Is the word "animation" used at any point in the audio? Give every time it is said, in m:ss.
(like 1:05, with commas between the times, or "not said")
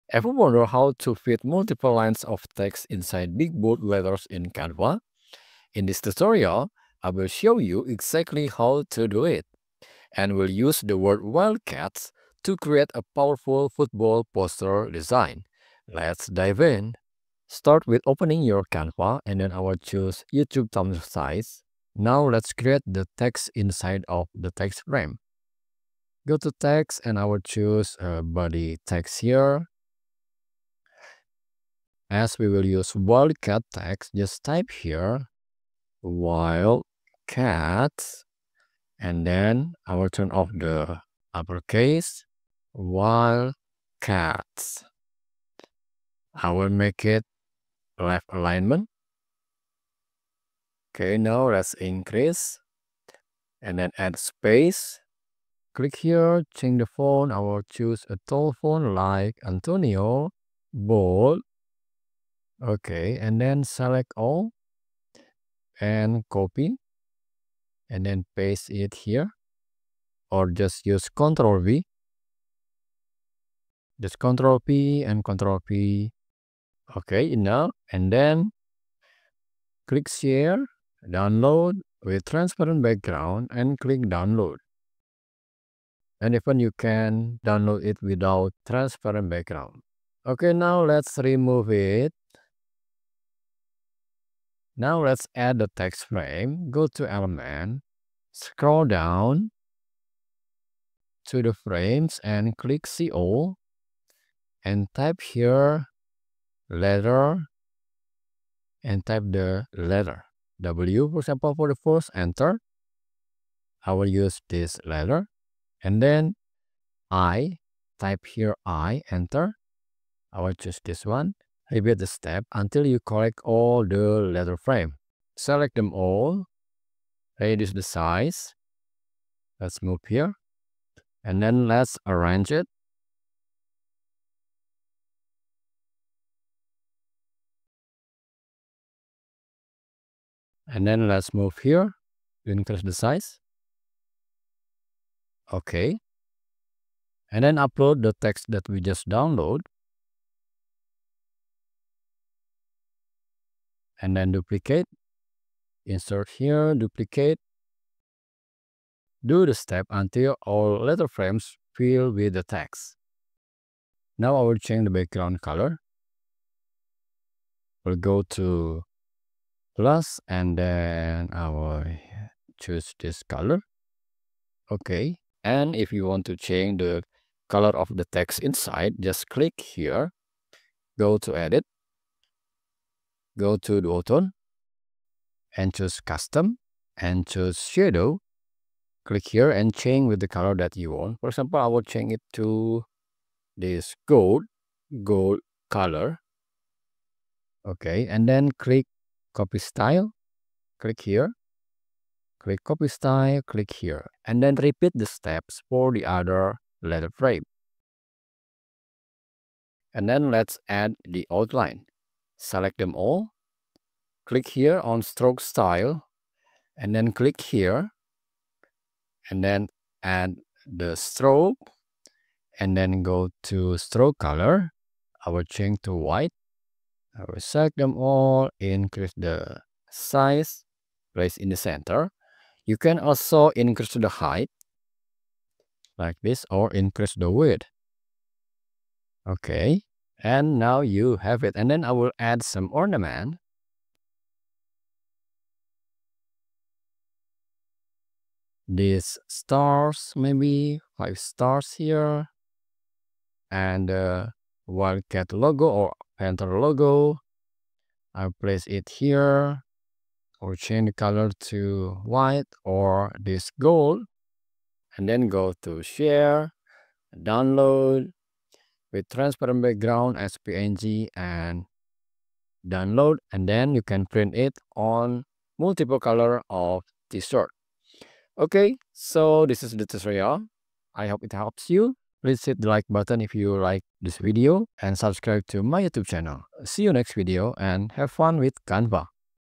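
not said.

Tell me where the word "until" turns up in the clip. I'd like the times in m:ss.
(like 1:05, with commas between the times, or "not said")
2:02, 2:39.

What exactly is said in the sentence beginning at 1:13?
Just Control P and Control P.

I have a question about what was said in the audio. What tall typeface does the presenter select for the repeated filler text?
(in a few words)
Antonio.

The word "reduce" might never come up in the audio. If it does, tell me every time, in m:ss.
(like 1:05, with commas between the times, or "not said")
2:07.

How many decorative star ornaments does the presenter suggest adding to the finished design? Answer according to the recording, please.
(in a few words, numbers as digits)
5.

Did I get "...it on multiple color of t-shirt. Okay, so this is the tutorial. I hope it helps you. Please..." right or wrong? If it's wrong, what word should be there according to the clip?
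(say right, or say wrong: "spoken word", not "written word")
right.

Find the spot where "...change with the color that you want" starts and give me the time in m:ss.
3:09.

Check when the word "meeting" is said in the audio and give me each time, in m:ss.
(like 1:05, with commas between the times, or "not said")
not said.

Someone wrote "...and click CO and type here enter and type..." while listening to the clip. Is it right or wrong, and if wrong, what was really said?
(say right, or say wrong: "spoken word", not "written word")
wrong: "letter", not "enter".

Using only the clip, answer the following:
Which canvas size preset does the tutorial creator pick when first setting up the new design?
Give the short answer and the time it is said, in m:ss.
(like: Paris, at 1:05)
YouTube thumbnail, at 0:20.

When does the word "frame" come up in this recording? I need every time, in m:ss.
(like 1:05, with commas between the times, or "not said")
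0:24, 1:36, 1:41, 2:04, 2:41, 3:27.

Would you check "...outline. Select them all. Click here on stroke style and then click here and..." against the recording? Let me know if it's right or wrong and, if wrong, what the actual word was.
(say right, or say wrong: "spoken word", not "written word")
right.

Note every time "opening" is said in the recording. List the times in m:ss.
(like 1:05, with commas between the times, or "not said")
0:18.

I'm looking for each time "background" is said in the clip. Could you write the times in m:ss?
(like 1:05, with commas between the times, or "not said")
1:22, 1:29, 2:44, 4:29.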